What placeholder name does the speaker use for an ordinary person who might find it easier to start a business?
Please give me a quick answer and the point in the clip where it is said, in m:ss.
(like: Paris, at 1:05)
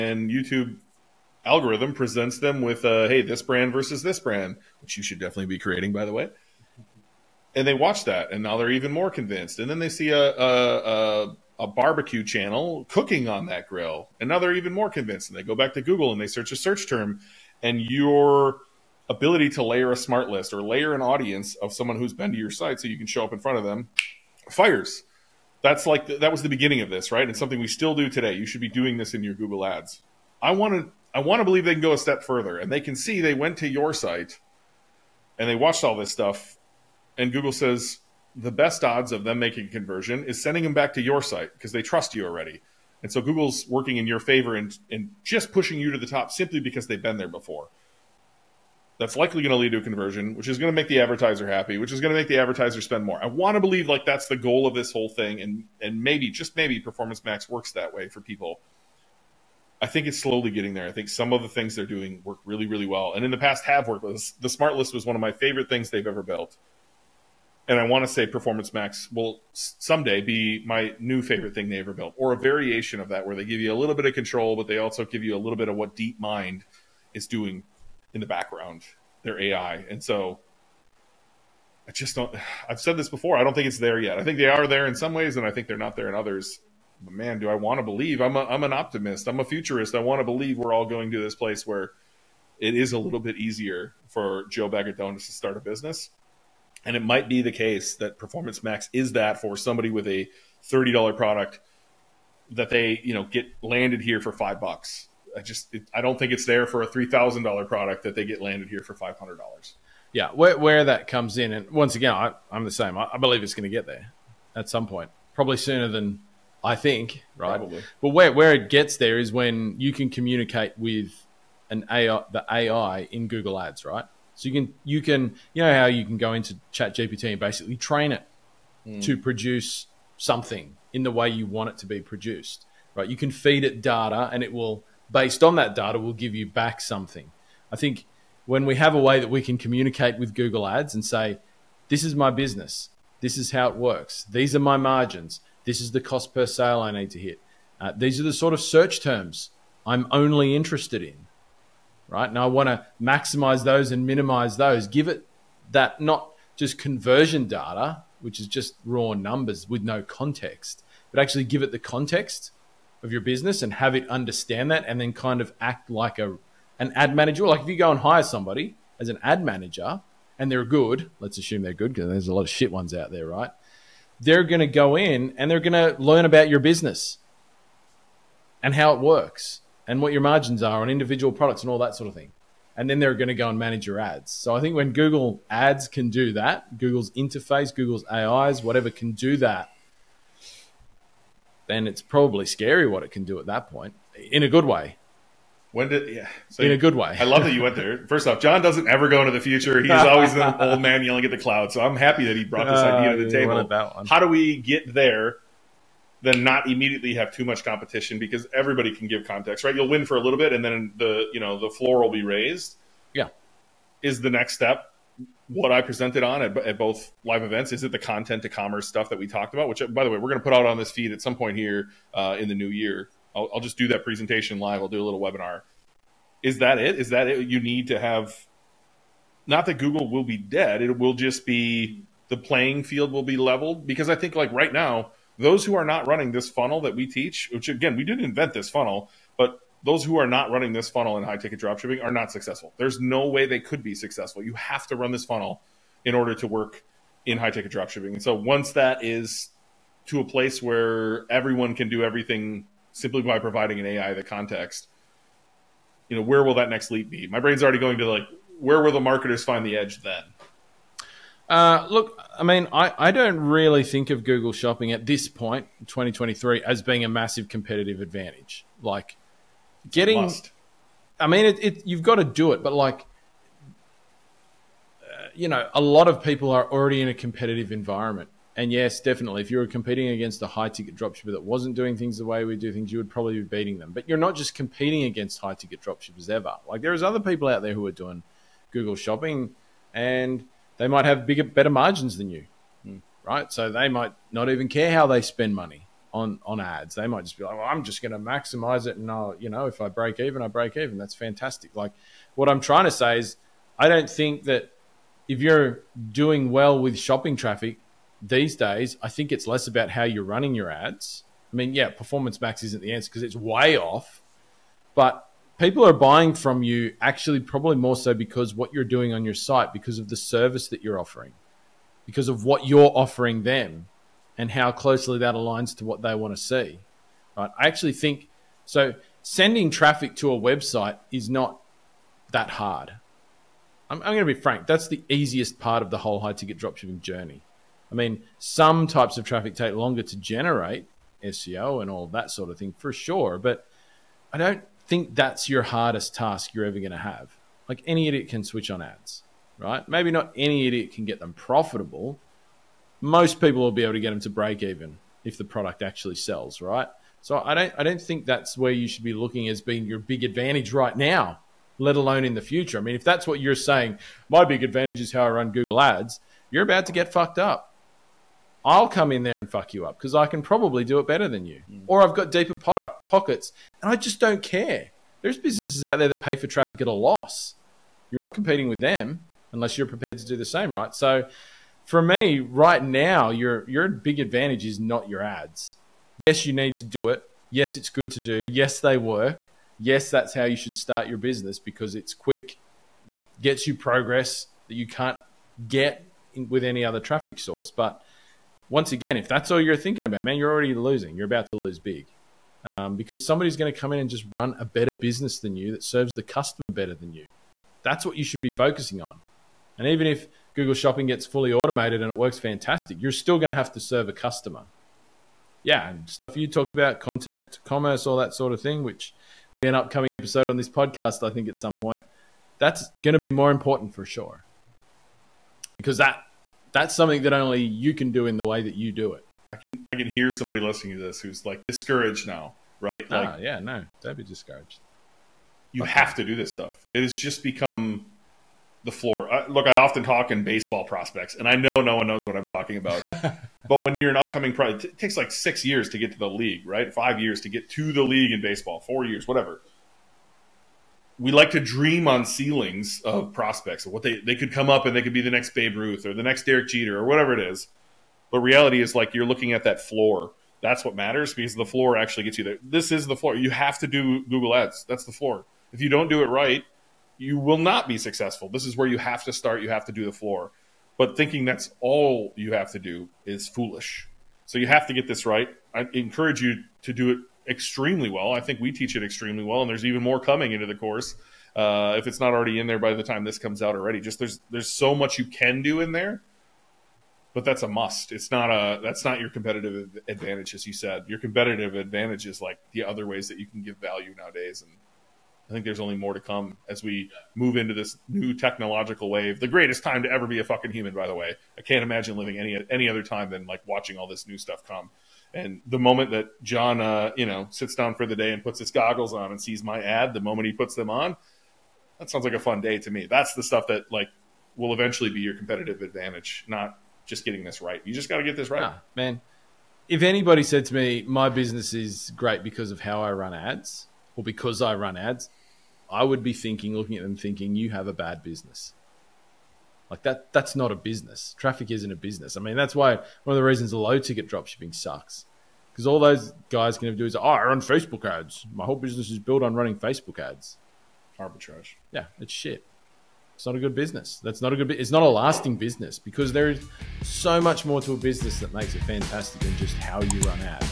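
Joe Bagatonis, at 1:34.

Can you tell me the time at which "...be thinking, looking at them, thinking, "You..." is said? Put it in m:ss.
8:46.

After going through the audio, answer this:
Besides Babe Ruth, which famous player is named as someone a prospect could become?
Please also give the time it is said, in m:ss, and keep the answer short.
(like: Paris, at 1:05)
Derek Jeter, at 7:36.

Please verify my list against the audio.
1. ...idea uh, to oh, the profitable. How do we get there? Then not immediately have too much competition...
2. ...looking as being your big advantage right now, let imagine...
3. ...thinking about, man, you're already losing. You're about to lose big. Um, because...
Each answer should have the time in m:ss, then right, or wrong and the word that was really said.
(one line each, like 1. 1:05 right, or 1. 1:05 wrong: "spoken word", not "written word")
1. 3:22 wrong: "table", not "profitable"
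2. 5:59 wrong: "alone", not "imagine"
3. 6:39 right.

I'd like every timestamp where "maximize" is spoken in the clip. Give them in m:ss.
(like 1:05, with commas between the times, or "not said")
2:33, 4:58.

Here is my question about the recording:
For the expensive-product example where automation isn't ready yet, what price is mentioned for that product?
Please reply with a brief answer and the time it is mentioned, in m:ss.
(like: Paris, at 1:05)
$3,000, at 1:46.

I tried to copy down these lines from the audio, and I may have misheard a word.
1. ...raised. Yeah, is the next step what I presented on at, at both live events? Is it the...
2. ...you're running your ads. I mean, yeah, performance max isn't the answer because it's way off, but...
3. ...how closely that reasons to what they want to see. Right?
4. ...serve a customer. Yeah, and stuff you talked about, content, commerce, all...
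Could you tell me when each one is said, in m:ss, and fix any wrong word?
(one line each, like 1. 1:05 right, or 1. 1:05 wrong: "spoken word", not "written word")
1. 3:32 right
2. 5:10 right
3. 5:24 wrong: "aligns", not "reasons"
4. 6:53 right.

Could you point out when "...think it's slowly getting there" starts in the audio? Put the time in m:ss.
0:59.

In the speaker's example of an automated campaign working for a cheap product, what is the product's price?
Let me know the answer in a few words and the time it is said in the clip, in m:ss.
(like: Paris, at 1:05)
$30, at 1:40.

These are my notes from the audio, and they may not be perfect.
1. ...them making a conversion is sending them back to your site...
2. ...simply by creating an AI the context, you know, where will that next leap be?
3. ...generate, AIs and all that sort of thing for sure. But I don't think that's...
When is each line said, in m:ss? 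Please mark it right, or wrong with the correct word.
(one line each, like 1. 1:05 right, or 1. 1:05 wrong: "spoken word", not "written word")
1. 0:39 right
2. 4:12 wrong: "providing", not "creating"
3. 5:40 wrong: "SEO", not "AIs".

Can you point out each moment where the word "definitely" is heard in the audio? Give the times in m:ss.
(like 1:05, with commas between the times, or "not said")
0:05, 4:38.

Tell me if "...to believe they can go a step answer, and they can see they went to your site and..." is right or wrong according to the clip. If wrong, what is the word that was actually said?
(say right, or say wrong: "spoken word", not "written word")
wrong: "further", not "answer".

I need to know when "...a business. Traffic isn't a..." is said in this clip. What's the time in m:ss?
8:50.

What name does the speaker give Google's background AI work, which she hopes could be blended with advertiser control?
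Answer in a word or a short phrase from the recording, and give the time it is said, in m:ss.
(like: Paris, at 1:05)
DeepMind, at 1:15.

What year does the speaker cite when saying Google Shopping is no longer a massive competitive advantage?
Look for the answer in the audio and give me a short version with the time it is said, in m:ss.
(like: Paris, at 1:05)
2023, at 4:25.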